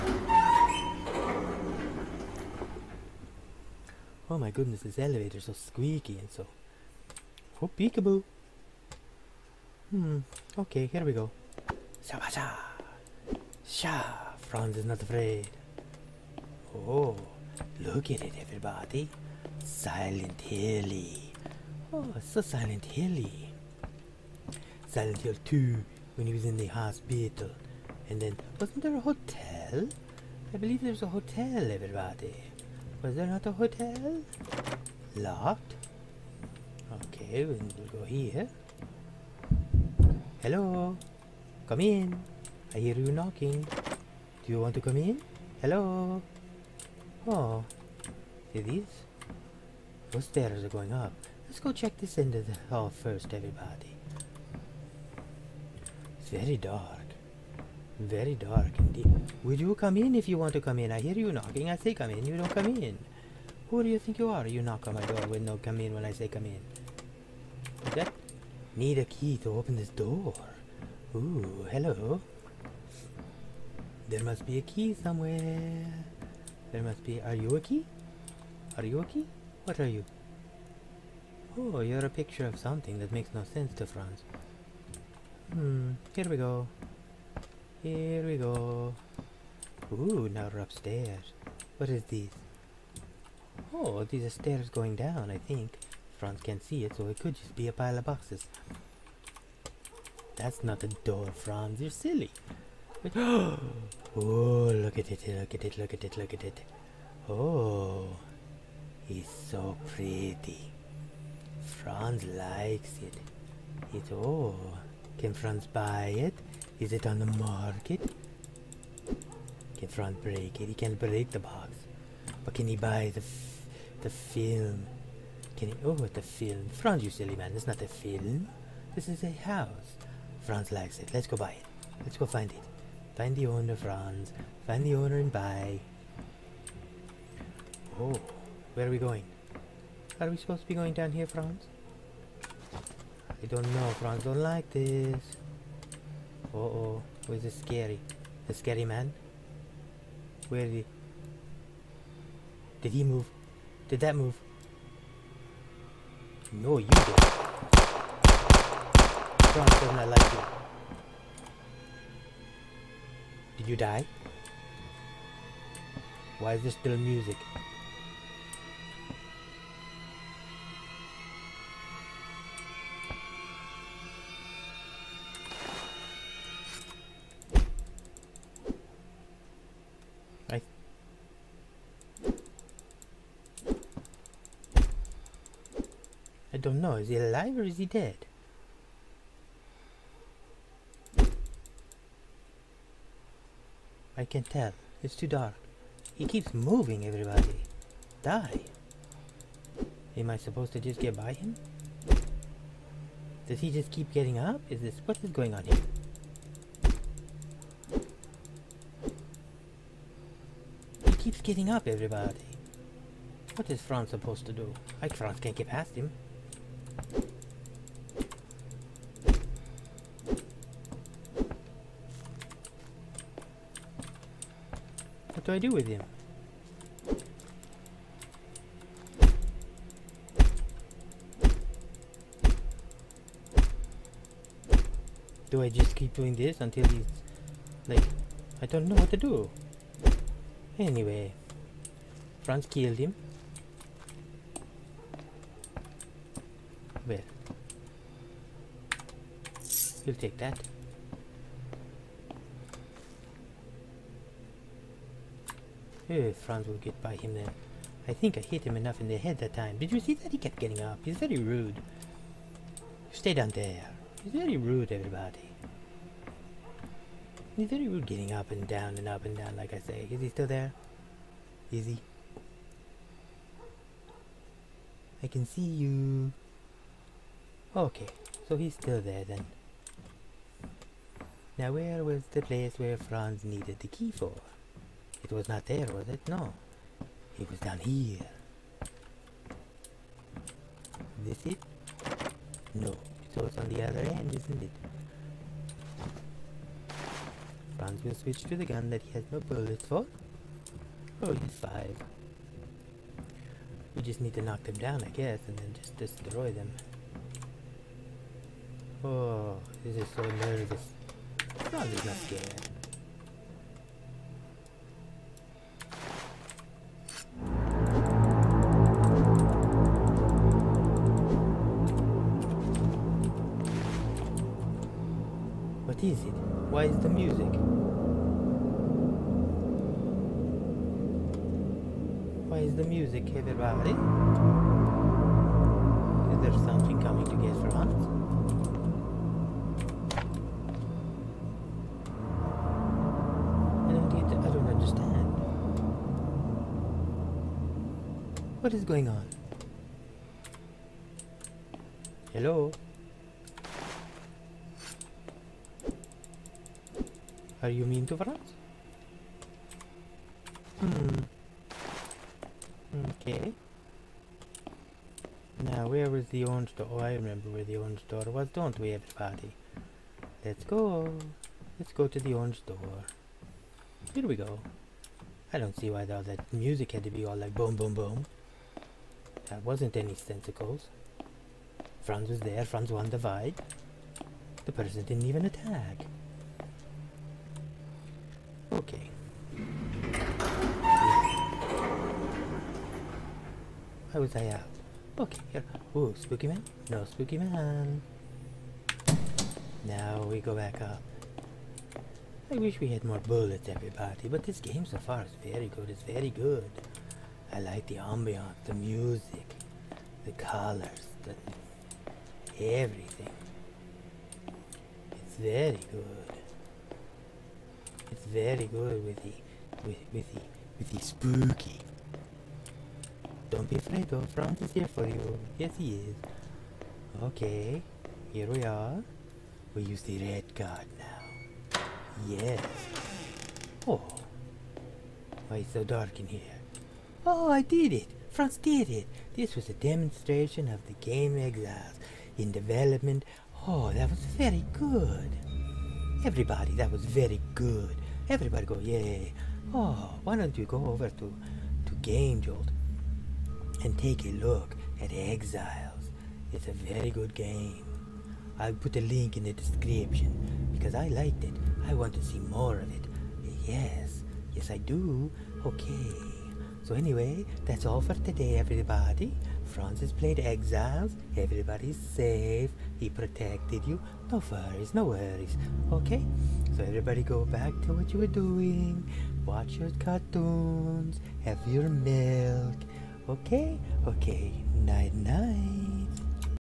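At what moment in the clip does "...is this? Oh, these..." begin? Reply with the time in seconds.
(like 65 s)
91 s.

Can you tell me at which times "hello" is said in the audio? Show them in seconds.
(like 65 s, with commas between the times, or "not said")
40 s, 45 s, 71 s, 352 s.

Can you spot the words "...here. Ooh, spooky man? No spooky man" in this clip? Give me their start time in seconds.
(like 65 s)
395 s.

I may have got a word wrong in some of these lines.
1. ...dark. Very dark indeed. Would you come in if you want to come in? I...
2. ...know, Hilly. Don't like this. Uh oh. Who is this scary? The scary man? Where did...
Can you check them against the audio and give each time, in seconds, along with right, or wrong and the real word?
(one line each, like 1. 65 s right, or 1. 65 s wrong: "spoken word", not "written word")
1. 56 s right
2. 143 s wrong: "Franz", not "Hilly".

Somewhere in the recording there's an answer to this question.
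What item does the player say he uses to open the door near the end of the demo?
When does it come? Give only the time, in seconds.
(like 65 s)
430 s.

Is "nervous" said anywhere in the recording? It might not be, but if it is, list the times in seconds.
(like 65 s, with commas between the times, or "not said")
310 s.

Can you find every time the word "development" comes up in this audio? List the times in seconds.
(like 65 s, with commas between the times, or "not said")
442 s.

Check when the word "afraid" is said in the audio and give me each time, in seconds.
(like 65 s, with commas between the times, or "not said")
15 s, 423 s.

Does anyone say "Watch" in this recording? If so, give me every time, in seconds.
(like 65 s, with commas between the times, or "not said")
479 s.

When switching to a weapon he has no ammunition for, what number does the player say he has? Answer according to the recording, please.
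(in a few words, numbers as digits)
Five.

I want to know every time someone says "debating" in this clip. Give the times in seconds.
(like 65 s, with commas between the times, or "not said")
not said.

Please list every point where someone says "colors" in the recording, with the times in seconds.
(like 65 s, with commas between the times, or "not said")
410 s.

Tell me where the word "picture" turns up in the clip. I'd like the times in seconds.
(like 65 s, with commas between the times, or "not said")
82 s.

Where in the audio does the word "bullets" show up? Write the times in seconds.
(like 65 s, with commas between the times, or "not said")
299 s, 403 s.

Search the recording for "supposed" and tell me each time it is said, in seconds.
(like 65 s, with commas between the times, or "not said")
140 s, 200 s, 214 s.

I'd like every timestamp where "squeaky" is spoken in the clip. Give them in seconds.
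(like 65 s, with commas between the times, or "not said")
5 s.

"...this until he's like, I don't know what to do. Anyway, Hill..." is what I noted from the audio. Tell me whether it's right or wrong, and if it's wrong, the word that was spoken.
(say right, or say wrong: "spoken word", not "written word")
wrong: "Franz", not "Hill".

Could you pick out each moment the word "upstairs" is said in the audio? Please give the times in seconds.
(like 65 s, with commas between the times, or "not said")
90 s.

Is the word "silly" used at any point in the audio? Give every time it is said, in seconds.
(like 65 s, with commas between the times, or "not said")
101 s, 127 s.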